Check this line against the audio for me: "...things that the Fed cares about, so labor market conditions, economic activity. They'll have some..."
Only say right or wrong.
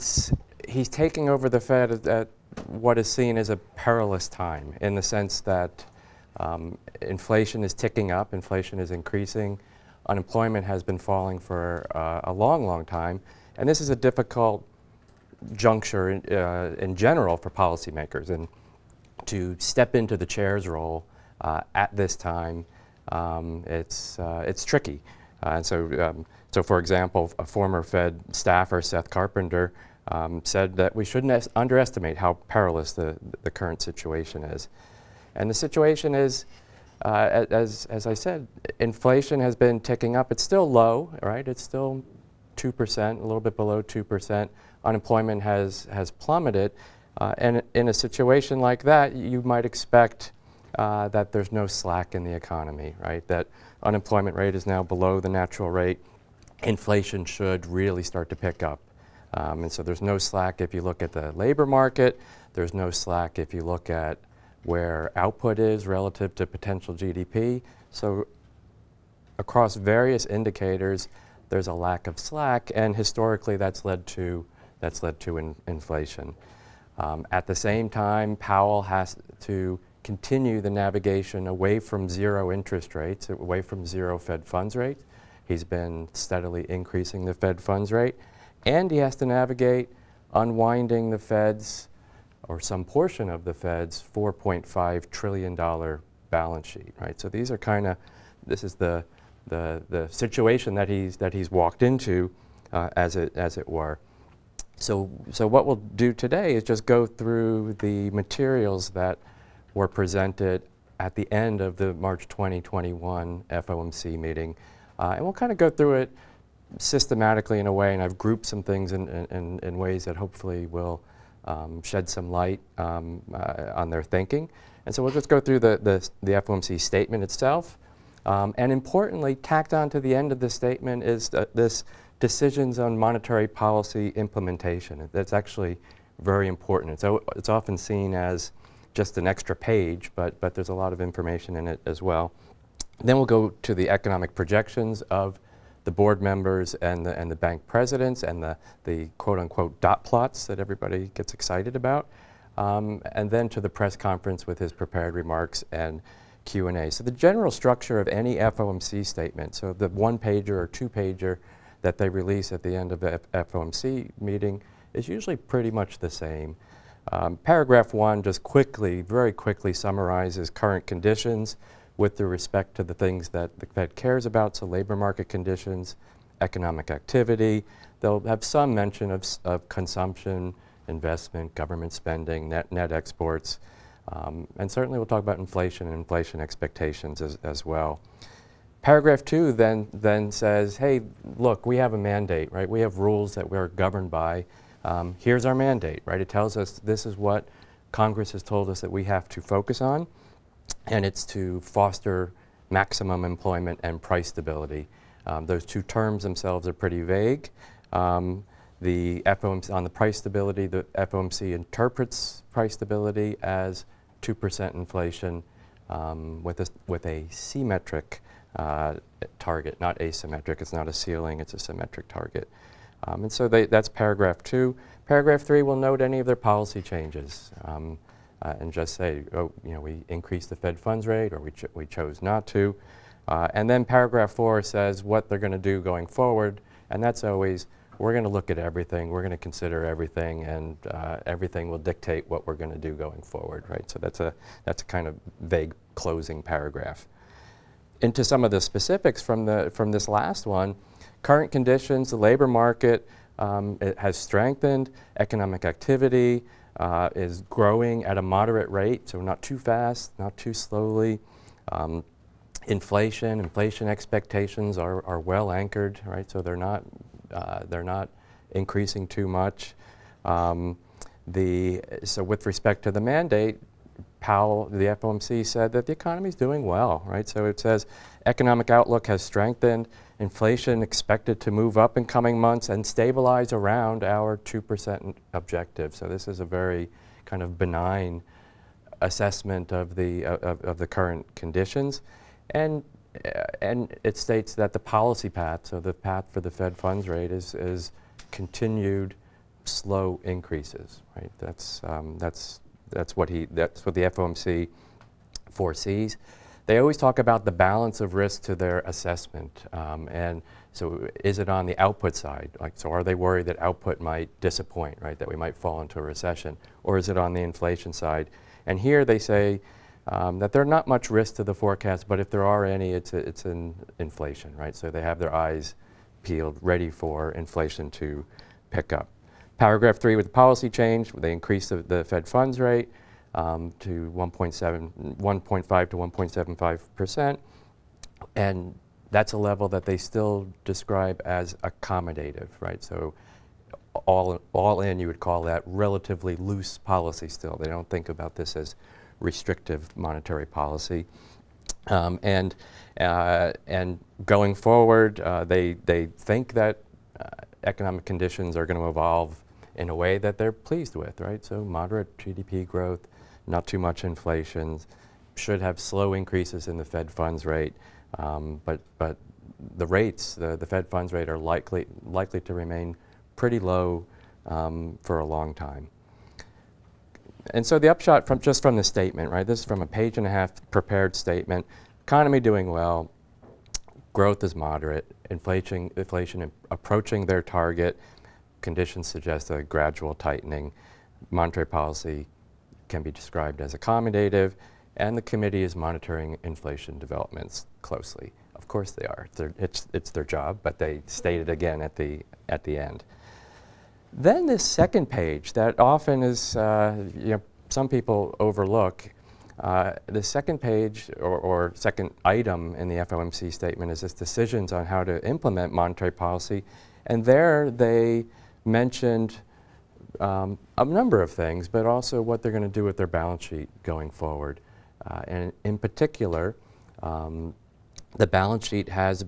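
right.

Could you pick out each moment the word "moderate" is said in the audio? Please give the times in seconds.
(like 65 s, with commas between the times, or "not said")
258 s, 361 s, 384 s.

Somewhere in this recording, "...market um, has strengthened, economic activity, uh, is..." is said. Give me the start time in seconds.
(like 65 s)
252 s.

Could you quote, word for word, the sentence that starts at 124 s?
And so we'll just go through the, the, the FOMC statement itself.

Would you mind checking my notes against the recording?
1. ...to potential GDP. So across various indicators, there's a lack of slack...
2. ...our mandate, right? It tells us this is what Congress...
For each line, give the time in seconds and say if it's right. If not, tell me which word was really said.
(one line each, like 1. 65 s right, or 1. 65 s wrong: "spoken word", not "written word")
1. 66 s right
2. 195 s right.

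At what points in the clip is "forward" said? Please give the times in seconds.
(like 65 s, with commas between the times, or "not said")
236 s, 243 s, 354 s, 424 s.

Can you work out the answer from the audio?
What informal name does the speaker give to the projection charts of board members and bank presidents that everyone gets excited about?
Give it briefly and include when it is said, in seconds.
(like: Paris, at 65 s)
dot plots, at 149 s.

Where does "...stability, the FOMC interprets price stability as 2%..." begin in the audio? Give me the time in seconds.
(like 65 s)
210 s.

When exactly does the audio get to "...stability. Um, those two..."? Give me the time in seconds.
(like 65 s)
204 s.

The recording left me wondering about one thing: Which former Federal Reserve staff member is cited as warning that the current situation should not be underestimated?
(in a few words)
Seth Carpenter.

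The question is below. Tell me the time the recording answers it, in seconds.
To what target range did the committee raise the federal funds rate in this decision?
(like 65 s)
335 s.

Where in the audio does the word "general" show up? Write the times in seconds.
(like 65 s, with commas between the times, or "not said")
16 s, 157 s.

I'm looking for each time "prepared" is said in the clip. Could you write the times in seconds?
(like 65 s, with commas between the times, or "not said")
154 s, 380 s.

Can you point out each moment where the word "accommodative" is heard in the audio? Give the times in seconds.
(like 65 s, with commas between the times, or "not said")
341 s, 393 s.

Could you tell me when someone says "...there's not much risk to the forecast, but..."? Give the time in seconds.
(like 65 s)
320 s.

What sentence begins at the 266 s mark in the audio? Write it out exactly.
So they're not, uh, they're not increasing too much.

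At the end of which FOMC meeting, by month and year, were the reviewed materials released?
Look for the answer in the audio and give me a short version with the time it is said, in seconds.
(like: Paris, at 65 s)
March 2021, at 111 s.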